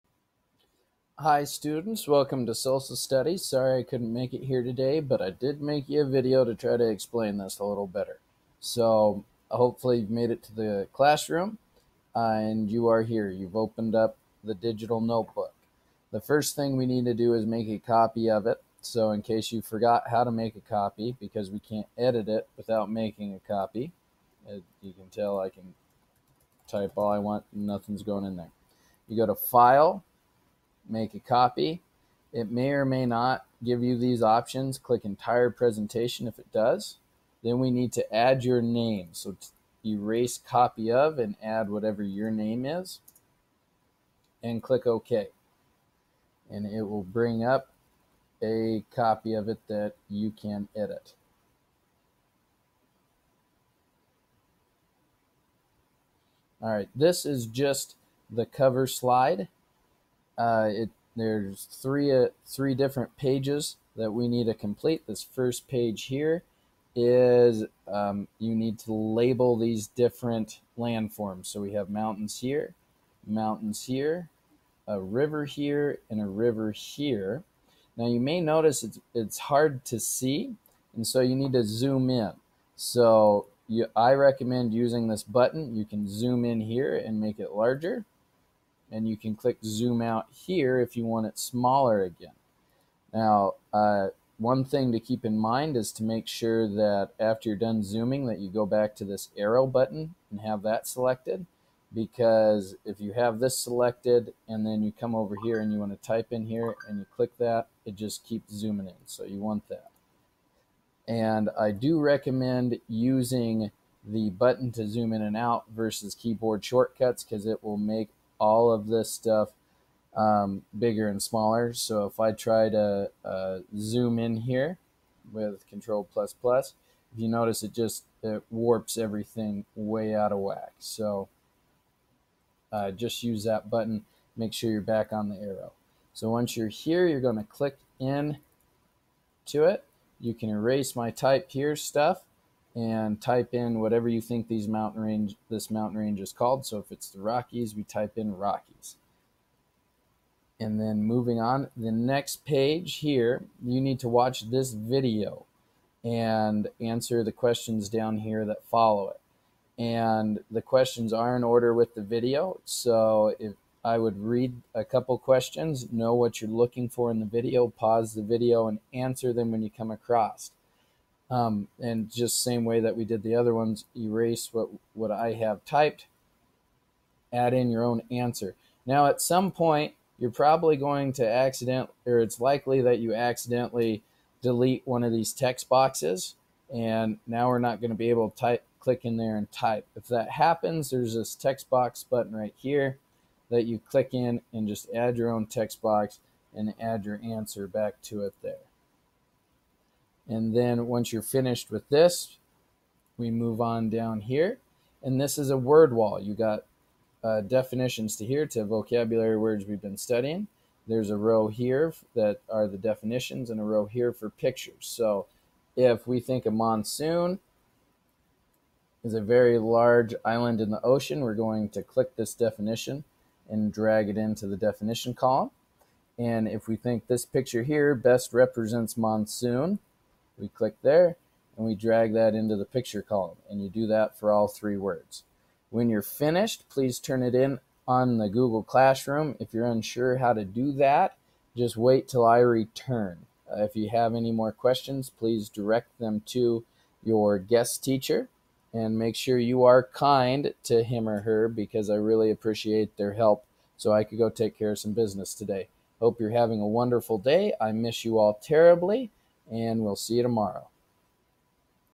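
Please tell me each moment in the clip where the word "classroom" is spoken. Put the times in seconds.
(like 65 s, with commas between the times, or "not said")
10 s, 238 s.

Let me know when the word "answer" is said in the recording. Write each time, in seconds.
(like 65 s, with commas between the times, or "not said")
156 s, 168 s, 178 s, 197 s.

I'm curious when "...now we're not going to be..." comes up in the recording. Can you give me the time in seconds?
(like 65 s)
187 s.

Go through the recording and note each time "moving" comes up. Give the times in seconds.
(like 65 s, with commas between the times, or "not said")
151 s.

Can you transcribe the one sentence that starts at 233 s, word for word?
And you do that for all three words.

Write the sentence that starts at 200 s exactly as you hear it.
And then once you're finished with this, we move on down here.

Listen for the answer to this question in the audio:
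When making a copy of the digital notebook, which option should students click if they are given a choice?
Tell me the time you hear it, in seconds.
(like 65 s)
35 s.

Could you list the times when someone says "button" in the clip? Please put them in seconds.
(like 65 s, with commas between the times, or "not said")
85 s, 99 s, 114 s, 133 s, 192 s.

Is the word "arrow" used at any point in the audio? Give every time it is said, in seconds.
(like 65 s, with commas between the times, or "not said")
99 s, 135 s.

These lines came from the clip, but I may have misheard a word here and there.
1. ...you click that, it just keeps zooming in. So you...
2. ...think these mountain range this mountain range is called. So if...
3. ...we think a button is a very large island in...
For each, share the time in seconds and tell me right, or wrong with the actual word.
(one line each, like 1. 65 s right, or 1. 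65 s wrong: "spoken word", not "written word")
1. 106 s right
2. 144 s right
3. 216 s wrong: "monsoon", not "button".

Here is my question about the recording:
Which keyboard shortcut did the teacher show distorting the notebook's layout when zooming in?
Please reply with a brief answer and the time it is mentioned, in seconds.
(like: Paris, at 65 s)
Control plus plus, at 125 s.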